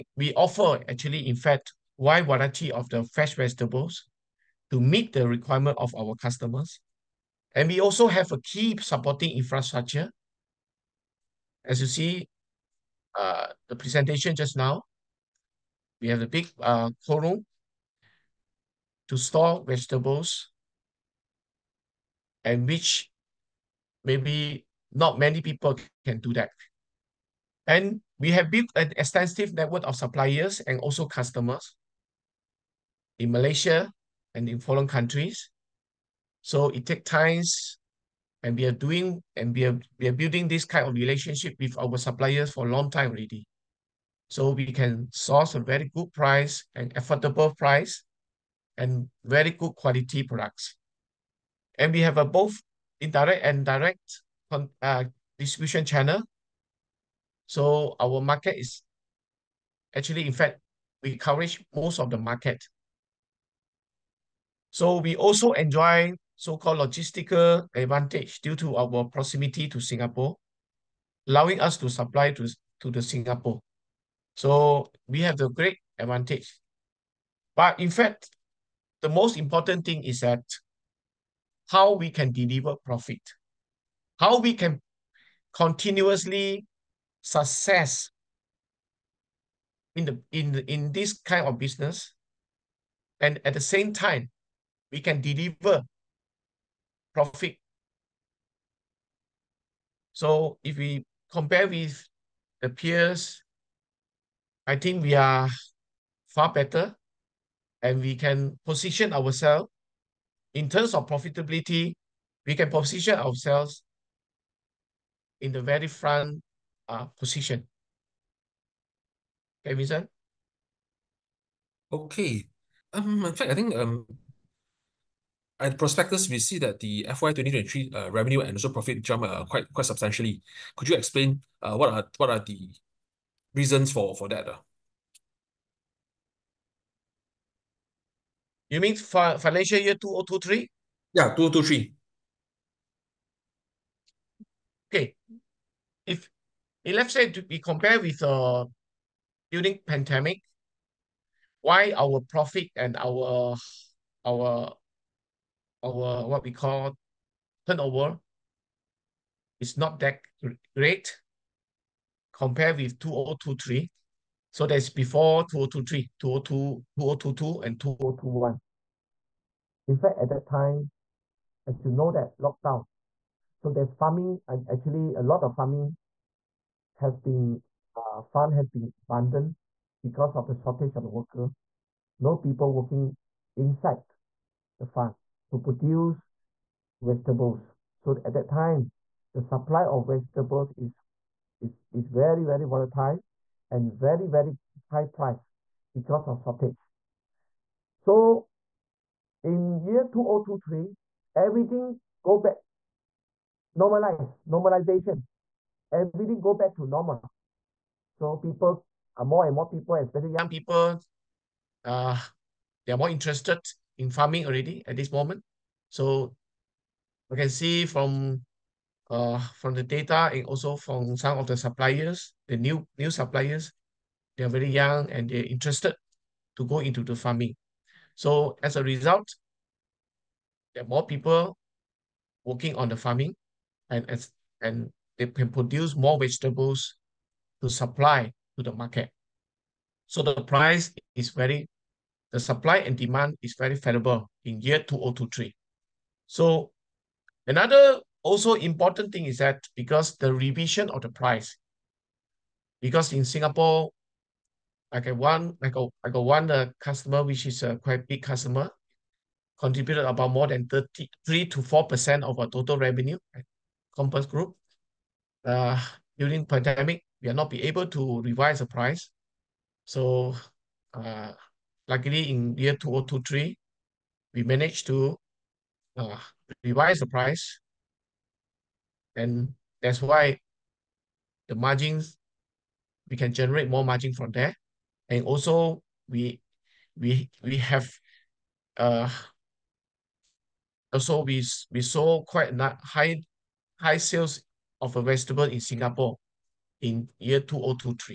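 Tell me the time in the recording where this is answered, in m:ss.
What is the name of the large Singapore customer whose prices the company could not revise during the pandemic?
4:23.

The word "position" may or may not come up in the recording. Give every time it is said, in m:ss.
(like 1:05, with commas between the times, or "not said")
1:48, 1:52, 1:57.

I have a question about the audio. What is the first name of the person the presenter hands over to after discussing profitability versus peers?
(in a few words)
Vincent.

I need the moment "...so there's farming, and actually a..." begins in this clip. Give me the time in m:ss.
2:53.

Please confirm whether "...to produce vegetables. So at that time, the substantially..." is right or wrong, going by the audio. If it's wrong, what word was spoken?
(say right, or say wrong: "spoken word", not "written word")
wrong: "supply", not "substantially".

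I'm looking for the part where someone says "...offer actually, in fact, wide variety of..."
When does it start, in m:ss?
0:00.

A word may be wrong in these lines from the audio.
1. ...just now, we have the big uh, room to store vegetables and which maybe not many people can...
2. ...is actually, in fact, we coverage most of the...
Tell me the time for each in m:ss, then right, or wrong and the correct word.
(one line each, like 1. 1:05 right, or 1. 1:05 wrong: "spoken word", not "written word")
1. 0:14 right
2. 0:58 right.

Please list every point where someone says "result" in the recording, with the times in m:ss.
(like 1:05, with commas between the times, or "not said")
3:48.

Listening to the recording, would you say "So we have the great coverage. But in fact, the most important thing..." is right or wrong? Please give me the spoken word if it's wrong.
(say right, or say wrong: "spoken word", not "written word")
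wrong: "advantage", not "coverage".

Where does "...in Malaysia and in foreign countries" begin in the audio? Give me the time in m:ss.
0:33.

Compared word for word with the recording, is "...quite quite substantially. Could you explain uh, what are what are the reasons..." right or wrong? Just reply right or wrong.
right.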